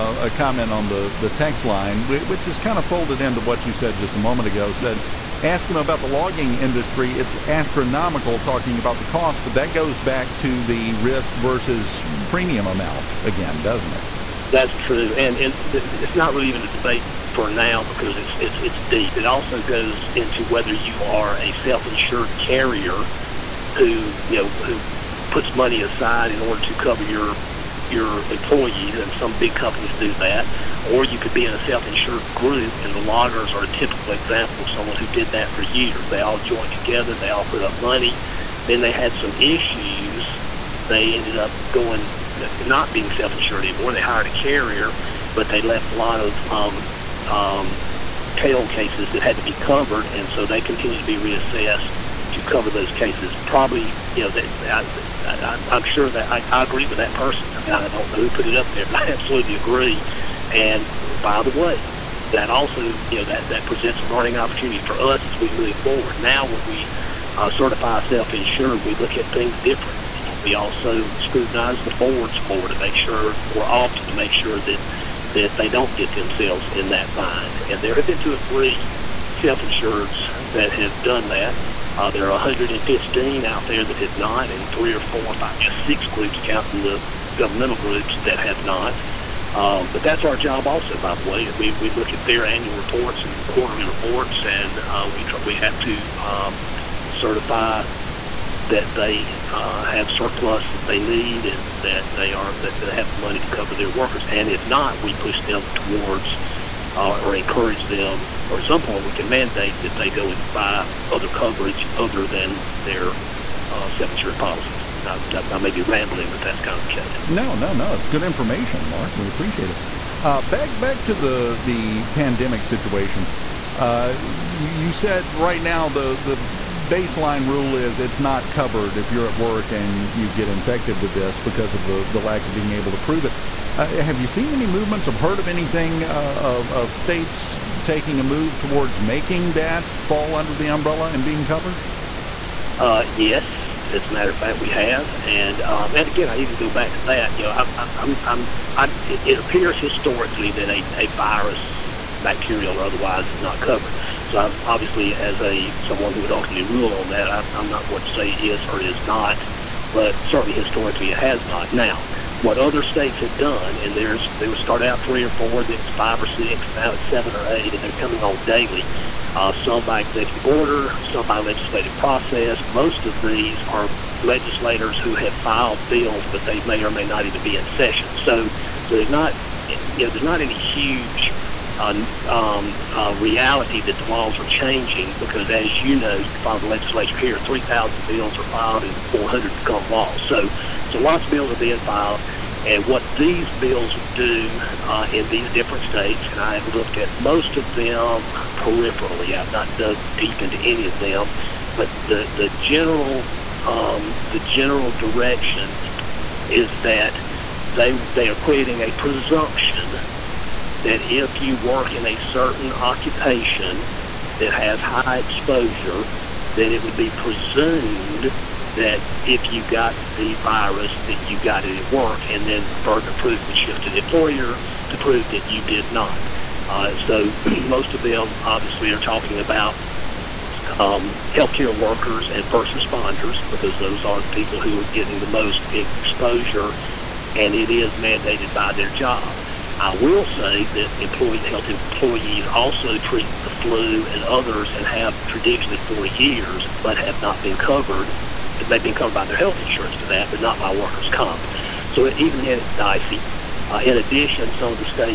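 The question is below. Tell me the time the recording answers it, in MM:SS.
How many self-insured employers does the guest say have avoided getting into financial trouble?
01:22.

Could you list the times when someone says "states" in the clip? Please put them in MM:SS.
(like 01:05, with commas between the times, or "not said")
02:16, 02:42, 03:15.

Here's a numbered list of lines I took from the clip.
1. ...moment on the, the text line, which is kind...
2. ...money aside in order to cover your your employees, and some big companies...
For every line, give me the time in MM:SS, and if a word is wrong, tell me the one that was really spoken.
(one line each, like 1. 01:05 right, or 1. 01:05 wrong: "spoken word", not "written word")
1. 00:00 wrong: "comment", not "moment"
2. 00:25 right.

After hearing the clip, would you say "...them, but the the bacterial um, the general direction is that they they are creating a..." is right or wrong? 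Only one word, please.
wrong.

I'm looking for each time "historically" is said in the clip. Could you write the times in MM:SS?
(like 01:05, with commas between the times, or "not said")
02:29, 02:40.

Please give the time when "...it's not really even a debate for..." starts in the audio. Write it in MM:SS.
00:15.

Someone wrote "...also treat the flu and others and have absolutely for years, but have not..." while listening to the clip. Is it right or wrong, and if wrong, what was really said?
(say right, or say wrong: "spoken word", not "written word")
wrong: "traditionally", not "absolutely".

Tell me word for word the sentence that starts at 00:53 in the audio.
Probably, you know, they, I, I'm, I'm sure that I, I agree with that person.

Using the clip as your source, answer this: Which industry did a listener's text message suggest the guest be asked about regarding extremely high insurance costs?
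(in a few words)
logging industry.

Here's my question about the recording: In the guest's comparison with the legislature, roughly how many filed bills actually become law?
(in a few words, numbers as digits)
400.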